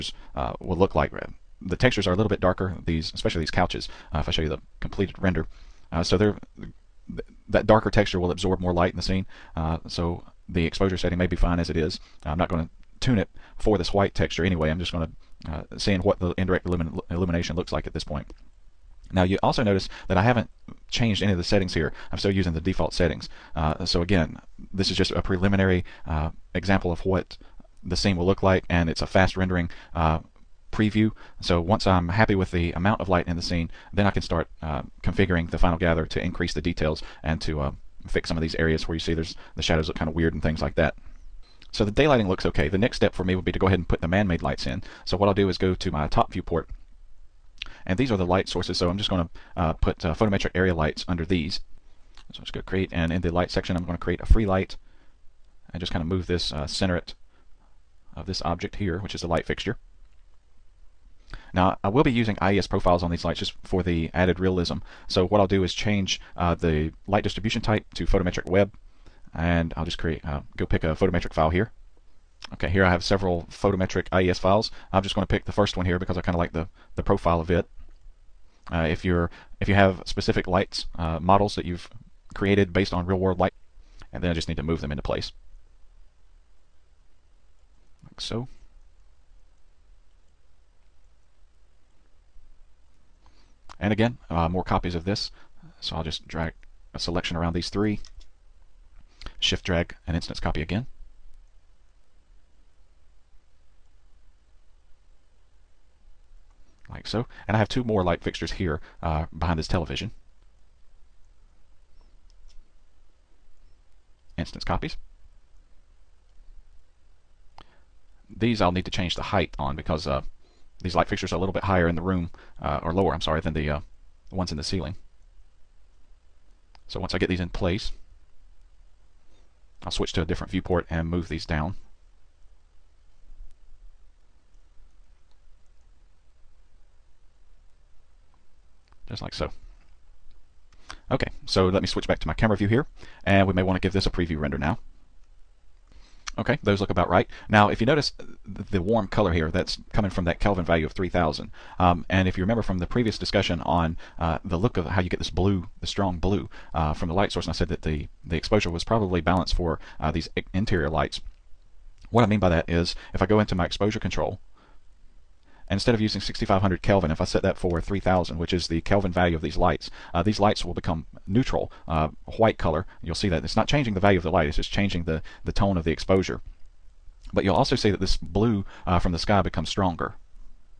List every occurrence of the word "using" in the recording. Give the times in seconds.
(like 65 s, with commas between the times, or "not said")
22 s, 62 s, 166 s.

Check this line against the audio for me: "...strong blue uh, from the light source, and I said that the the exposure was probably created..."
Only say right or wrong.
wrong.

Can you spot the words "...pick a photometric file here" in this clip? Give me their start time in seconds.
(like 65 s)
70 s.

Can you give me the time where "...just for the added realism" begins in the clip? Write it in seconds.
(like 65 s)
63 s.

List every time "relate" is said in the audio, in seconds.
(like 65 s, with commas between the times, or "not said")
not said.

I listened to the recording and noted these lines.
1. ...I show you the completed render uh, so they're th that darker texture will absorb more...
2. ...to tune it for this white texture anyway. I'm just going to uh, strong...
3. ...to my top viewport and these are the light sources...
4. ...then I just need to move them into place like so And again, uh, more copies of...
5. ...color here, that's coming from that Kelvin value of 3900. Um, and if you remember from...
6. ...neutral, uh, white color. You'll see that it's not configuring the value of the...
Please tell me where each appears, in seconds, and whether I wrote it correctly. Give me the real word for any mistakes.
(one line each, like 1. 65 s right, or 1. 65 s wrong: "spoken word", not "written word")
1. 4 s right
2. 12 s wrong: "seeing", not "strong"
3. 45 s right
4. 84 s right
5. 149 s wrong: "3000", not "3900"
6. 171 s wrong: "changing", not "configuring".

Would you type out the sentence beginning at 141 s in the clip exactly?
Okay, so let me switch back to my camera view here, and we may want to give this a preview render now.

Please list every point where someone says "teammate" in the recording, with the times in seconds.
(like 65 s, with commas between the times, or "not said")
not said.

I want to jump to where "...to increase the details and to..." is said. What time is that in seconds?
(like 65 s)
36 s.